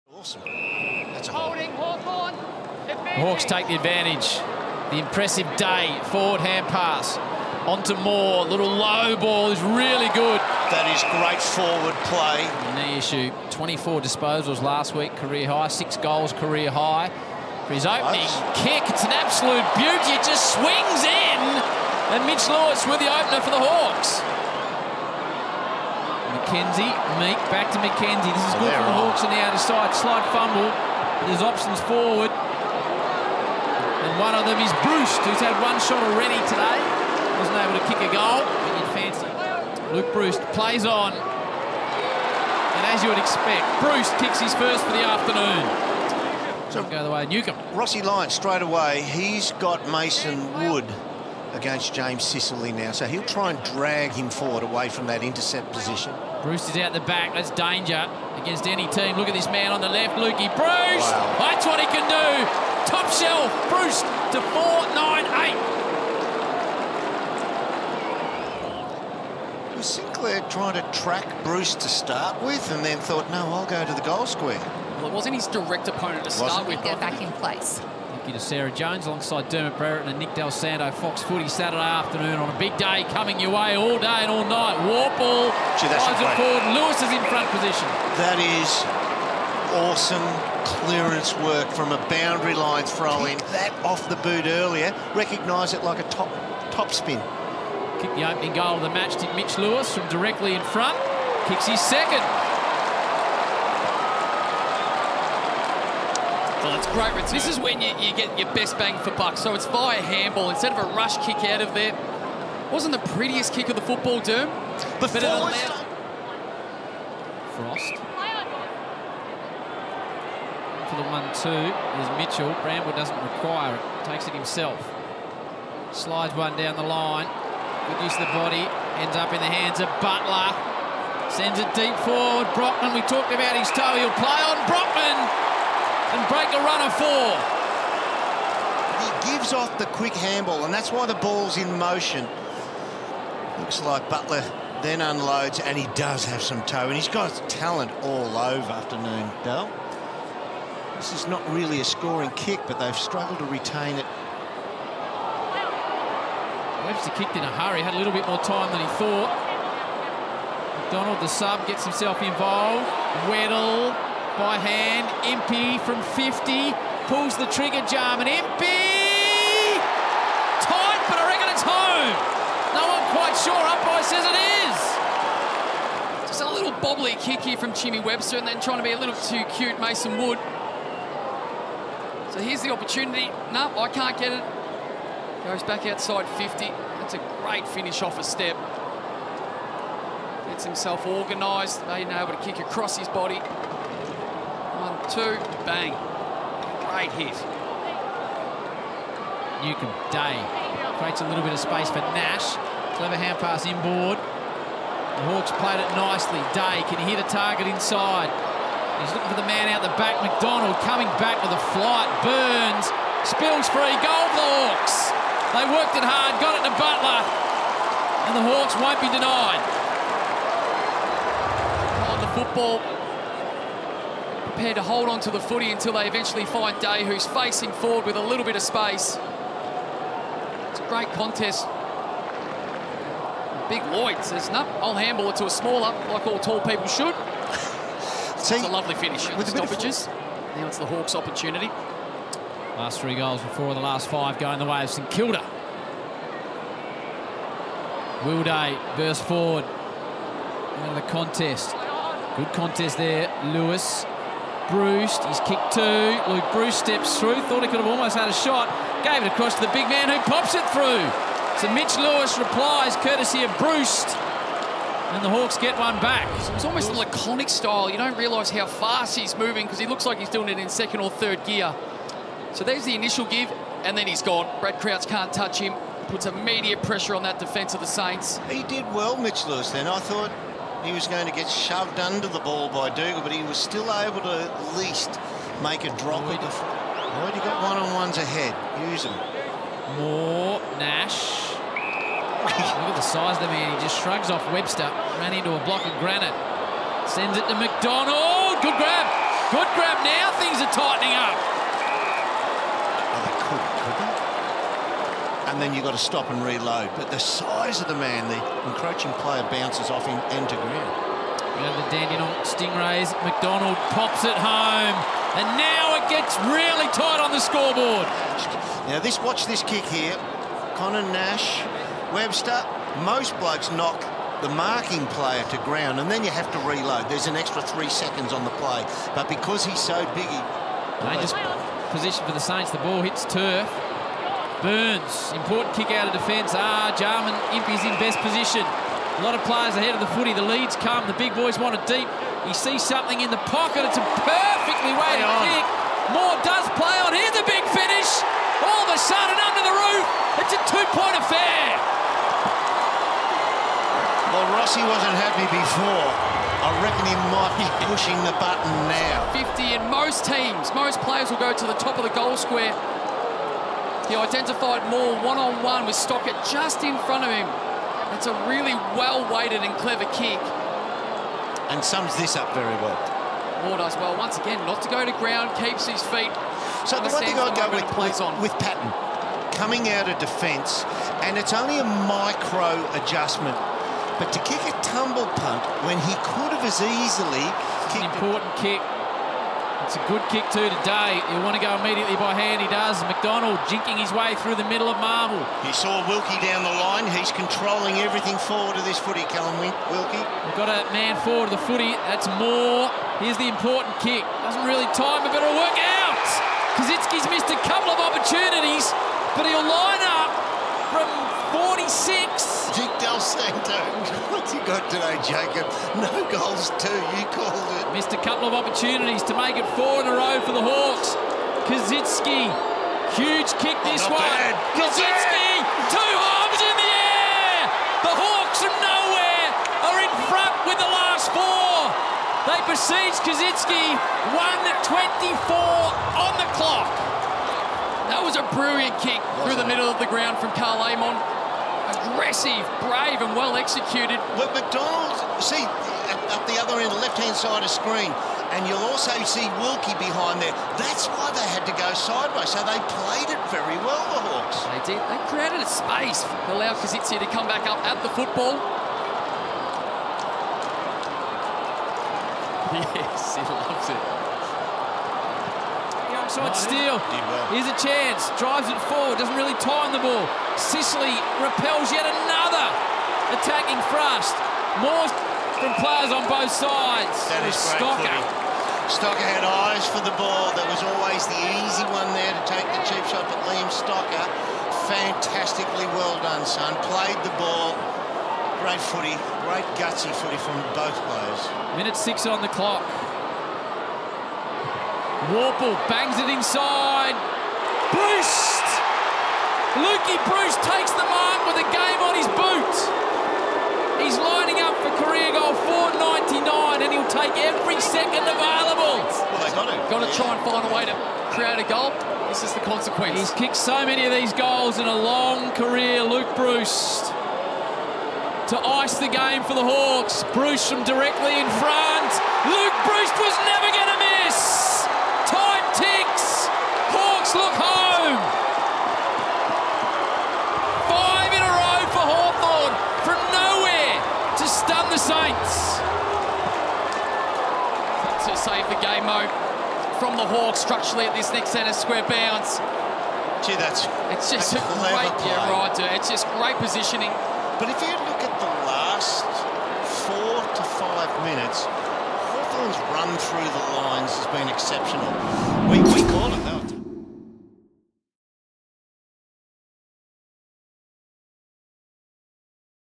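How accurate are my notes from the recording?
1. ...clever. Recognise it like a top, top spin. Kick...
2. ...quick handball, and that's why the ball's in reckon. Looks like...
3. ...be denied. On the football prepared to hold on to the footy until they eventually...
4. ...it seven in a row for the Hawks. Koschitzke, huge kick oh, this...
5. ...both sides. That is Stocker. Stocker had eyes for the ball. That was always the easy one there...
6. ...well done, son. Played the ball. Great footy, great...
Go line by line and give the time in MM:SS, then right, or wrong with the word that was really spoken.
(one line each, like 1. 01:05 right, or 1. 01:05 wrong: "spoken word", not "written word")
1. 01:34 wrong: "earlier", not "clever"
2. 02:19 wrong: "motion", not "reckon"
3. 03:38 right
4. 06:59 wrong: "four", not "seven"
5. 07:56 right
6. 08:05 right.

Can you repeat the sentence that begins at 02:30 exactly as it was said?
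This is not really a scoring kick, but they've struggled to retain it.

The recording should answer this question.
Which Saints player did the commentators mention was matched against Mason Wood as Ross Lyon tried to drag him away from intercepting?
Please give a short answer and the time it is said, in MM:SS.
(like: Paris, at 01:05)
James Sicily, at 00:51.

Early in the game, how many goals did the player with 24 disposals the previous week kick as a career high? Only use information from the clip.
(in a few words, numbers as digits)
6.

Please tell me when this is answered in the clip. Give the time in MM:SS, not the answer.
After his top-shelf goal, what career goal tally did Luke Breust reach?
01:04.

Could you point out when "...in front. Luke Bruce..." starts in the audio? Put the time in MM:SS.
08:41.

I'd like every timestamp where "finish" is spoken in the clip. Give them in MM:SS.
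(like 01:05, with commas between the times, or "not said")
03:07, 03:58, 05:47.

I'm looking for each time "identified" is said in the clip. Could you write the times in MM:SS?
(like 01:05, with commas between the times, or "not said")
06:04.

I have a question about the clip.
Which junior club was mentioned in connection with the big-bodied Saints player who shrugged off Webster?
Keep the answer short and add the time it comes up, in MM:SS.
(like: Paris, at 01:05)
Dandenong Stingrays, at 05:11.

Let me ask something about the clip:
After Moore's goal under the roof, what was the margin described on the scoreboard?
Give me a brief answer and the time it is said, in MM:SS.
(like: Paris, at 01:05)
2 points, at 05:50.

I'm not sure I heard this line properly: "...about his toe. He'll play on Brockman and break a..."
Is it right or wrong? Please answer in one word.
right.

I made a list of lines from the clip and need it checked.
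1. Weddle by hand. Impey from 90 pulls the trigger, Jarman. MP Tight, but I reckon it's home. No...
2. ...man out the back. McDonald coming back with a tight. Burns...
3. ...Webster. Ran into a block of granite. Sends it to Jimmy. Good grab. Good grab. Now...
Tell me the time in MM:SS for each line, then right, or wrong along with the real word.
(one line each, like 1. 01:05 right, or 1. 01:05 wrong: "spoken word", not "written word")
1. 02:43 wrong: "50", not "90"
2. 03:29 wrong: "flight", not "tight"
3. 04:54 wrong: "McDonald", not "Jimmy".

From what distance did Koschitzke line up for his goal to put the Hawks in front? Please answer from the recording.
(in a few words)
46.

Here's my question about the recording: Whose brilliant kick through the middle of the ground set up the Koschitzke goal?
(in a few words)
Karl Amon.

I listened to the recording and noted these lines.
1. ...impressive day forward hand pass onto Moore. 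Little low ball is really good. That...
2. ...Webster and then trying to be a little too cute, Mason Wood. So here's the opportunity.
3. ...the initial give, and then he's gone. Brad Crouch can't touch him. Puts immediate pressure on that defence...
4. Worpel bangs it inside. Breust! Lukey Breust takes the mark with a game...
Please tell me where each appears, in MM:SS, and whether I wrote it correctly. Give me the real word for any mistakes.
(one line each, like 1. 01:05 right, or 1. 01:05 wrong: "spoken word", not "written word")
1. 00:04 right
2. 02:57 right
3. 04:32 right
4. 08:15 right.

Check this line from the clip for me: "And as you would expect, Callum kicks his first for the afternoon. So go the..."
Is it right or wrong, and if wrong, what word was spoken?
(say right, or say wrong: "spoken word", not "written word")
wrong: "Breust", not "Callum".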